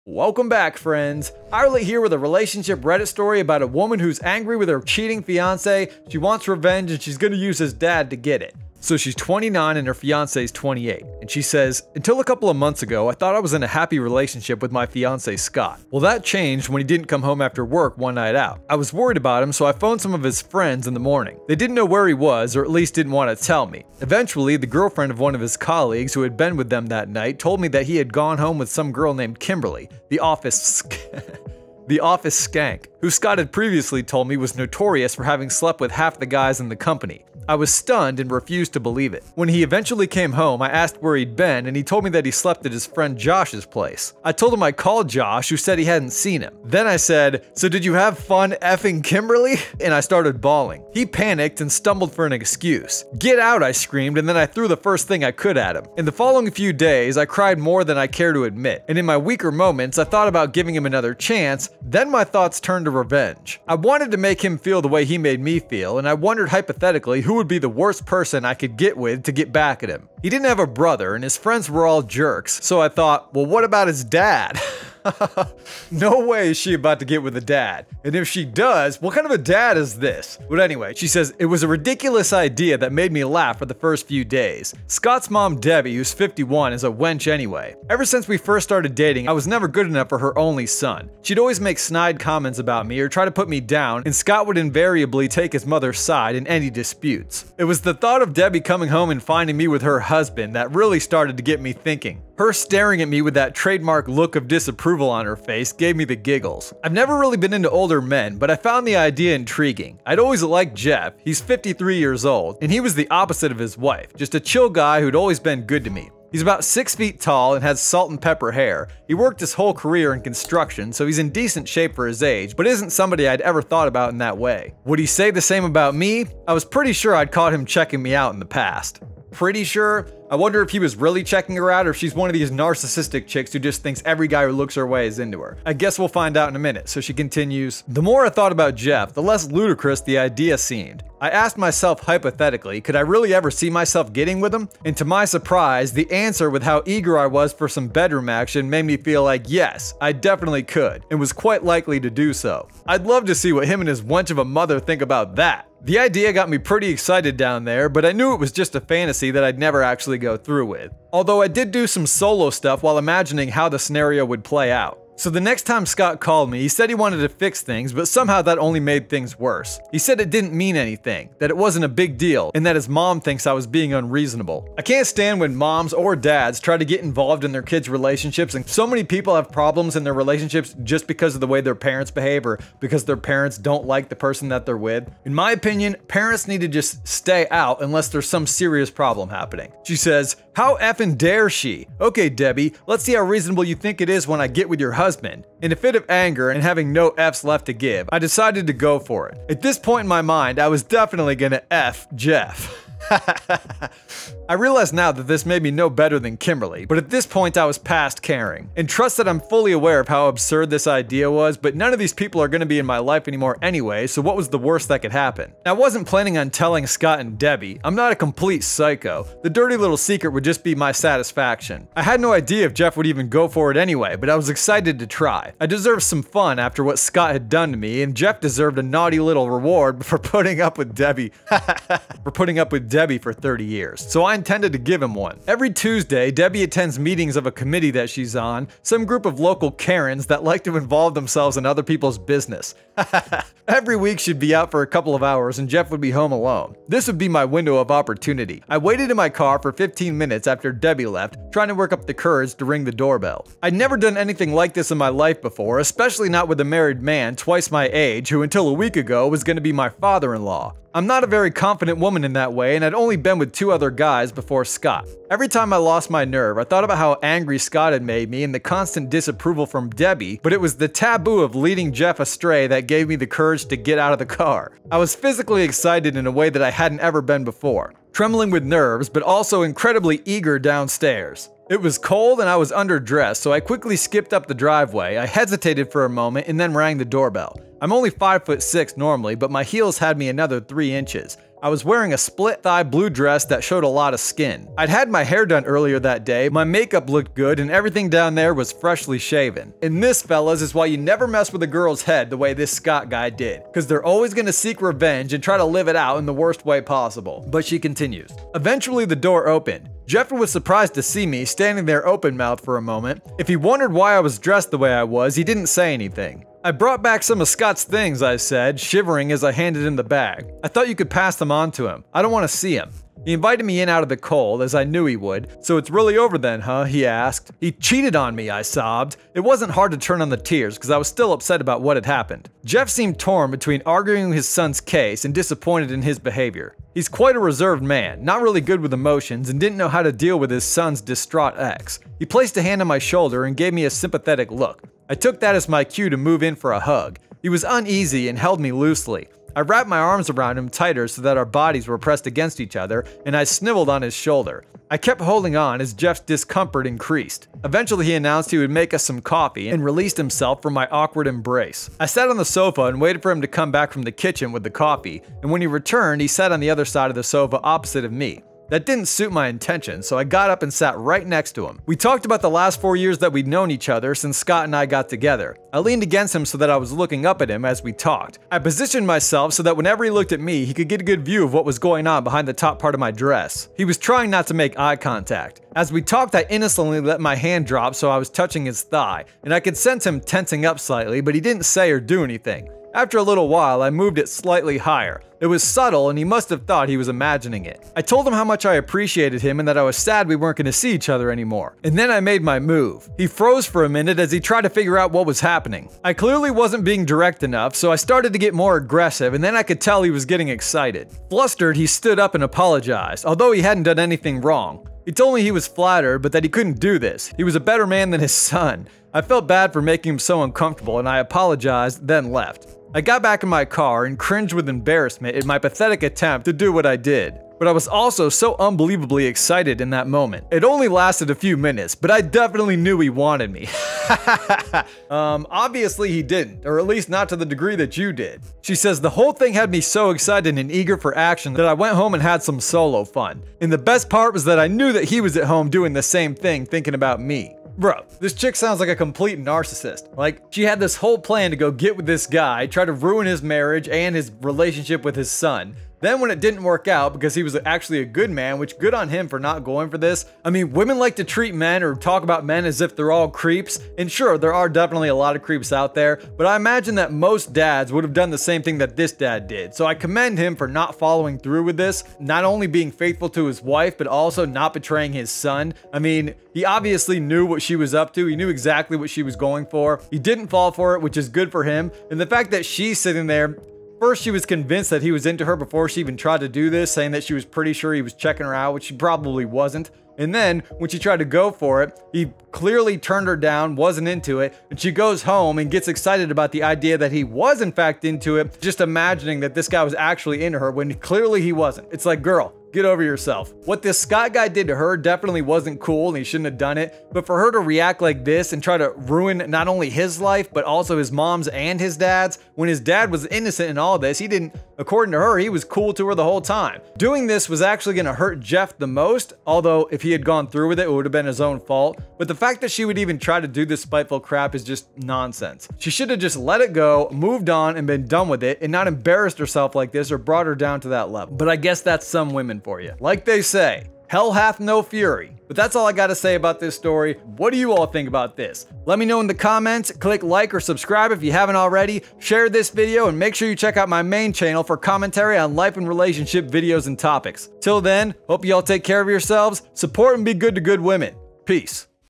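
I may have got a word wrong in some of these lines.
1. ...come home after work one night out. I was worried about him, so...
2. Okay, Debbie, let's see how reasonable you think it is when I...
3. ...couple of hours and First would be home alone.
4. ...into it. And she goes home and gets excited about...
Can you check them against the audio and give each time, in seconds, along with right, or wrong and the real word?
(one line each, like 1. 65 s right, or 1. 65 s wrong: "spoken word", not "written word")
1. 17 s right
2. 192 s right
3. 244 s wrong: "Jeff", not "First"
4. 494 s right.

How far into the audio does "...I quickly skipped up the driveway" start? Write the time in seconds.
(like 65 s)
283 s.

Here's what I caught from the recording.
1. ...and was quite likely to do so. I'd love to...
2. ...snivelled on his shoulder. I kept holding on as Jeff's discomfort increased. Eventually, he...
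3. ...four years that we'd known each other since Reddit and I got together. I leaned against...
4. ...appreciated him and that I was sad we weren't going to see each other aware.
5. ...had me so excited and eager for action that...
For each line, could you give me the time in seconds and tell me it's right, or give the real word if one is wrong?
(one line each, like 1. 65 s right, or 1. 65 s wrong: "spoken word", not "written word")
1. 151 s right
2. 353 s right
3. 372 s wrong: "Scott", not "Reddit"
4. 398 s wrong: "anymore", not "aware"
5. 439 s right.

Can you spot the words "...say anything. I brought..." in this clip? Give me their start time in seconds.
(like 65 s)
315 s.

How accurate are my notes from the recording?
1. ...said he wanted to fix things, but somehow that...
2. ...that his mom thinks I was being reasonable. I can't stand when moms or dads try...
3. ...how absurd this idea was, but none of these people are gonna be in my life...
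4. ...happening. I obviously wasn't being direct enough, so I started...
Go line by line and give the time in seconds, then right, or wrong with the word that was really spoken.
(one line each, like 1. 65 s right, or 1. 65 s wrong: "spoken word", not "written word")
1. 166 s right
2. 172 s wrong: "unreasonable", not "reasonable"
3. 210 s right
4. 405 s wrong: "clearly", not "obviously".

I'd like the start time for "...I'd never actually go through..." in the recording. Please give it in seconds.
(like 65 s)
159 s.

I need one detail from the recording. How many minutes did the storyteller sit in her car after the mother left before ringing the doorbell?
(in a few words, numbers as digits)
15.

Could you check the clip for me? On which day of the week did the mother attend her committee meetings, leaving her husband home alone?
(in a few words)
Tuesday.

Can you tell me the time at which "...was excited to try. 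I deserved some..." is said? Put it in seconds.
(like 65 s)
224 s.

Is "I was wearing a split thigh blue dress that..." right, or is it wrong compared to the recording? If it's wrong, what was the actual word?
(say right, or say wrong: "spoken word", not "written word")
right.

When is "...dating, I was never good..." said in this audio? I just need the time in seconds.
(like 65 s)
88 s.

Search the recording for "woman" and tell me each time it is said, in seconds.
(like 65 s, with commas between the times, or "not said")
3 s, 261 s.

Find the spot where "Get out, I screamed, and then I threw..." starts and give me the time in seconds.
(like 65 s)
53 s.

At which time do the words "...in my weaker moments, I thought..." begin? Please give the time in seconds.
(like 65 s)
58 s.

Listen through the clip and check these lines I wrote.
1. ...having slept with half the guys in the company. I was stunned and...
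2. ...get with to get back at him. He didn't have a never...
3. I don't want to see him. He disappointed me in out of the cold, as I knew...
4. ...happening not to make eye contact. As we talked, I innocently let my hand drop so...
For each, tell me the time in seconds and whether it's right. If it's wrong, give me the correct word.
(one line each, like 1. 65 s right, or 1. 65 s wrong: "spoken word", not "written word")
1. 35 s right
2. 68 s wrong: "brother", not "never"
3. 322 s wrong: "invited", not "disappointed"
4. 383 s wrong: "trying", not "happening".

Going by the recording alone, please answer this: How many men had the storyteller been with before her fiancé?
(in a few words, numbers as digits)
2.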